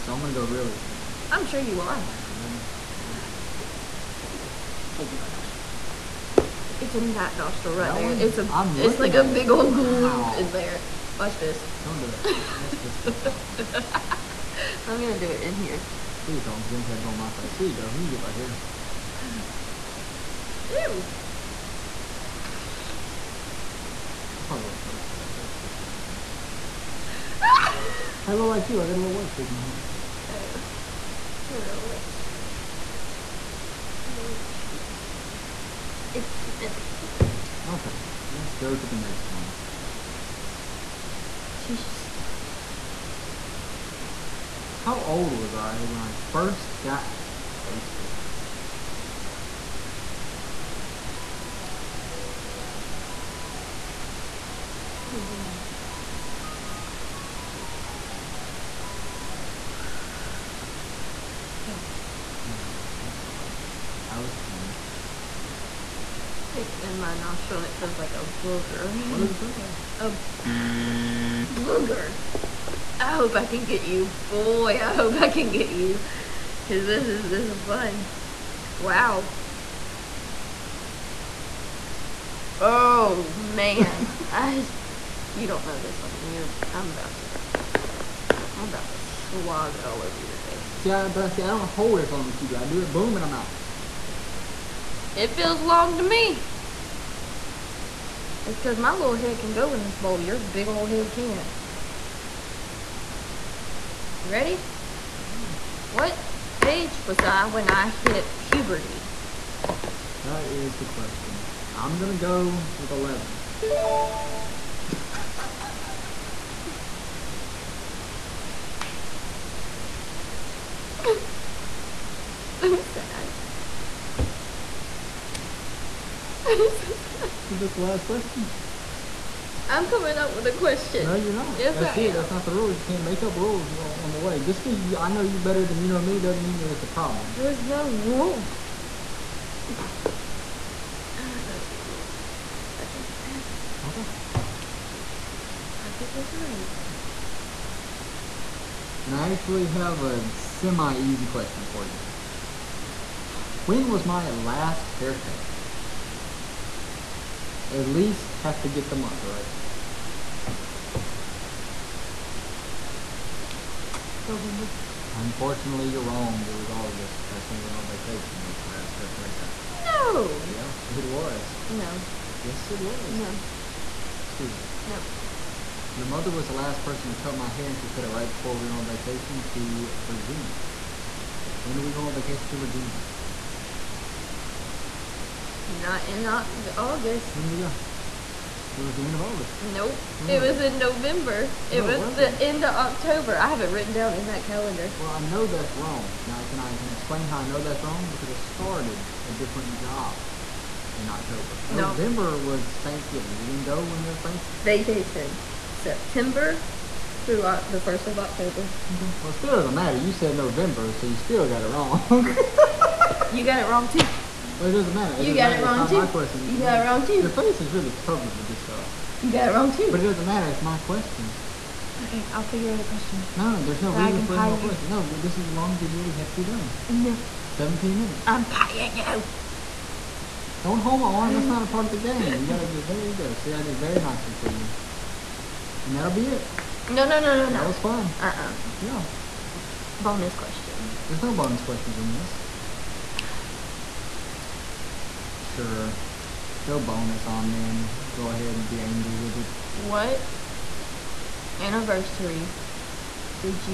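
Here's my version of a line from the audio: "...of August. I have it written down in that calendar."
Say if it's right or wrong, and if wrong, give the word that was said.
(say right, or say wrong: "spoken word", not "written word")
wrong: "October", not "August".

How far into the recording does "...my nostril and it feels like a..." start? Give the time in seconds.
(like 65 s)
66 s.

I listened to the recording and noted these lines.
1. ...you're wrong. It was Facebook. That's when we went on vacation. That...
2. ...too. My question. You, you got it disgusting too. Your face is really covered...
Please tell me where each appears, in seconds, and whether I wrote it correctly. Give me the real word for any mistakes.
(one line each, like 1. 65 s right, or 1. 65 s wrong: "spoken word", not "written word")
1. 165 s wrong: "August", not "Facebook"
2. 216 s wrong: "wrong", not "disgusting".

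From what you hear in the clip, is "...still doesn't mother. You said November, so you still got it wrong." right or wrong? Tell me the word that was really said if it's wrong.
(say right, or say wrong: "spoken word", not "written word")
wrong: "matter", not "mother".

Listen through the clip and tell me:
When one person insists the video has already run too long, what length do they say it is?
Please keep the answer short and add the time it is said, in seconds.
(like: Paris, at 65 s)
17 minutes, at 227 s.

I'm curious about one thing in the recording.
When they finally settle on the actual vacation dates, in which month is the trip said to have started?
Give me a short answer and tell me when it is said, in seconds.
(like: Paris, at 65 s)
September, at 205 s.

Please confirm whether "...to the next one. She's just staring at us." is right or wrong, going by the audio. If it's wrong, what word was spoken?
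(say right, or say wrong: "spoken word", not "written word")
right.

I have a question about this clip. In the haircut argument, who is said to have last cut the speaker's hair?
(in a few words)
Your mother.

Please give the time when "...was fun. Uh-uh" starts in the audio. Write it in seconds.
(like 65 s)
237 s.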